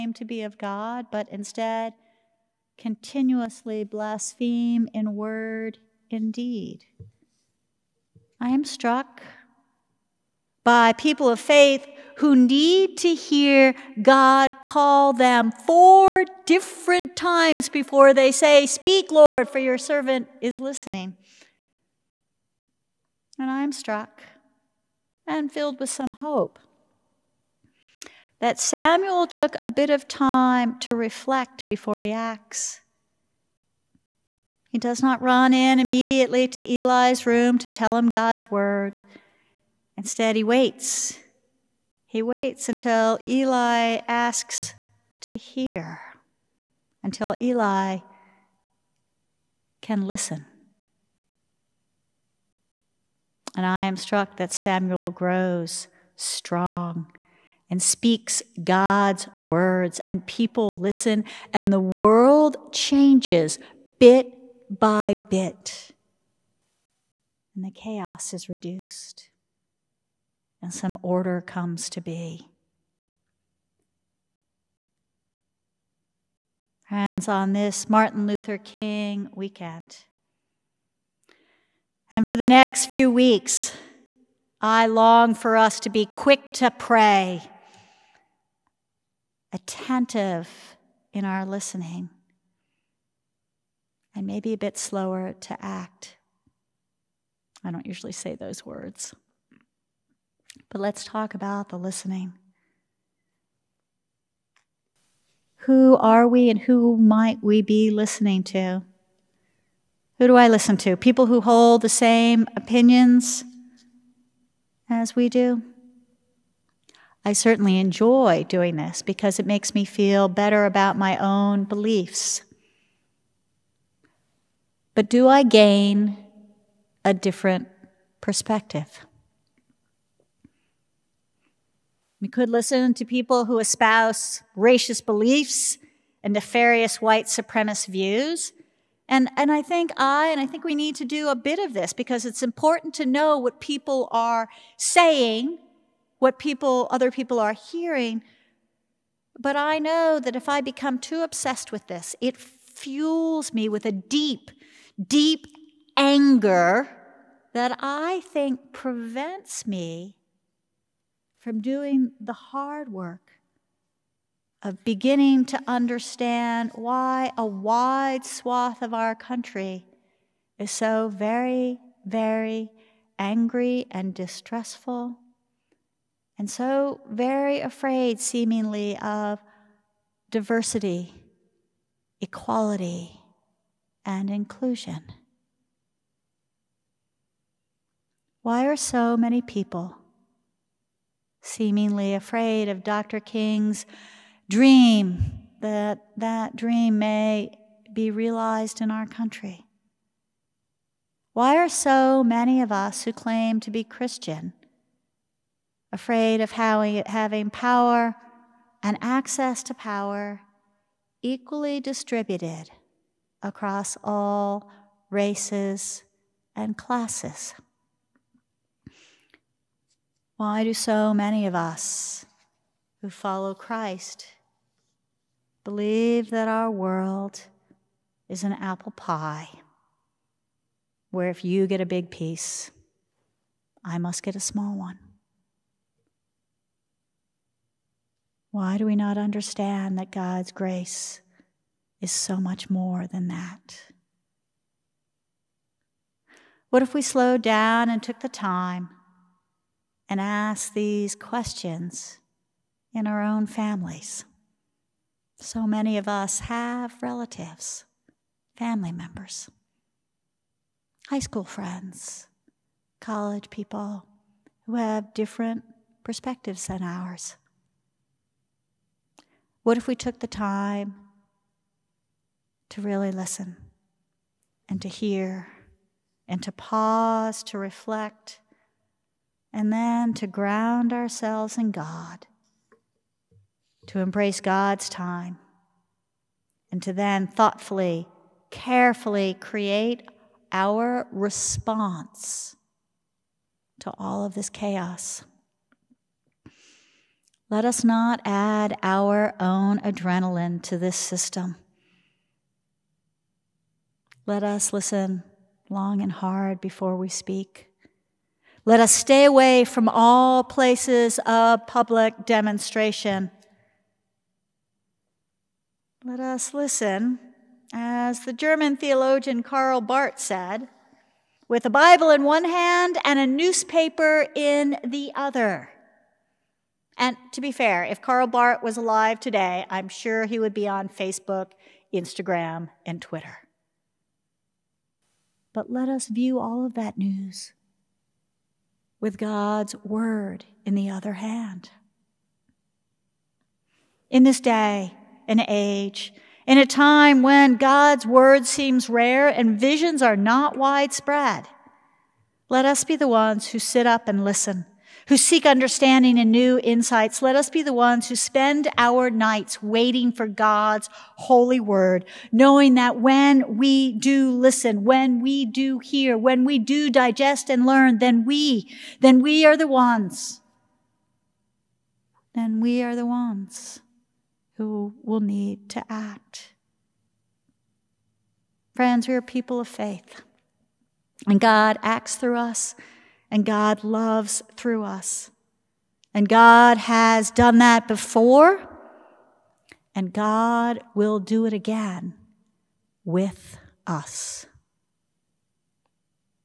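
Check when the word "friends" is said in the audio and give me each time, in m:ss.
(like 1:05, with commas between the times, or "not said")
4:21, 6:18.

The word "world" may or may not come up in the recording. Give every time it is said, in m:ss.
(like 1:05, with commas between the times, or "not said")
1:01, 3:46.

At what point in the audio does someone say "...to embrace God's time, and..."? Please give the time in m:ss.
4:43.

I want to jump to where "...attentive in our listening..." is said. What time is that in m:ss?
1:29.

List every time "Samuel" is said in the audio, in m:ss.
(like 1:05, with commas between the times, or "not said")
0:28, 0:54.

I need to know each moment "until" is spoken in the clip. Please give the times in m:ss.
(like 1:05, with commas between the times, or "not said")
0:42, 0:47.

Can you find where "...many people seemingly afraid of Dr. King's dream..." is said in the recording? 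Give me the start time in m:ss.
3:09.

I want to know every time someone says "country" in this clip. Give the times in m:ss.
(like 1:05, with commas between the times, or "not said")
2:49, 3:19.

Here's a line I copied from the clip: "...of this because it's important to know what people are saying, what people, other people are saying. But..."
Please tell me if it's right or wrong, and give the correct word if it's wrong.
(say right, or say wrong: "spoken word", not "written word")
wrong: "hearing", not "saying".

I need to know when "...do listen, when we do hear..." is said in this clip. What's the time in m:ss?
6:03.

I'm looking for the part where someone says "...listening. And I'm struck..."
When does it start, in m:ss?
0:20.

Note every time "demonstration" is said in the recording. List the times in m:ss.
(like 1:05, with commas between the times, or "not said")
5:12.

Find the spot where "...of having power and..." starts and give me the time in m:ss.
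3:26.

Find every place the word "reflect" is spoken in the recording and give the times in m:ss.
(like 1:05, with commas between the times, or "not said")
0:30, 4:37.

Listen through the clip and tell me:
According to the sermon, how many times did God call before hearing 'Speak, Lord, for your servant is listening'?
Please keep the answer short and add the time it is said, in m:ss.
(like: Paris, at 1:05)
4, at 0:15.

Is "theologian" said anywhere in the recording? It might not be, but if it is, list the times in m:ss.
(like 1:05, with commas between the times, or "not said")
5:18.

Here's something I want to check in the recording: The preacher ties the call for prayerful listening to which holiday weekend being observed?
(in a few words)
Martin Luther King weekend.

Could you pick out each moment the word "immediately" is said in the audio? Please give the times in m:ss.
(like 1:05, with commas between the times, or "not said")
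0:35.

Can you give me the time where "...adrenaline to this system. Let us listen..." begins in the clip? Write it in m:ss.
4:59.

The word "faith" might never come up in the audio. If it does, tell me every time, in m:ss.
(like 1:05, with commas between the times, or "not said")
0:11, 6:19.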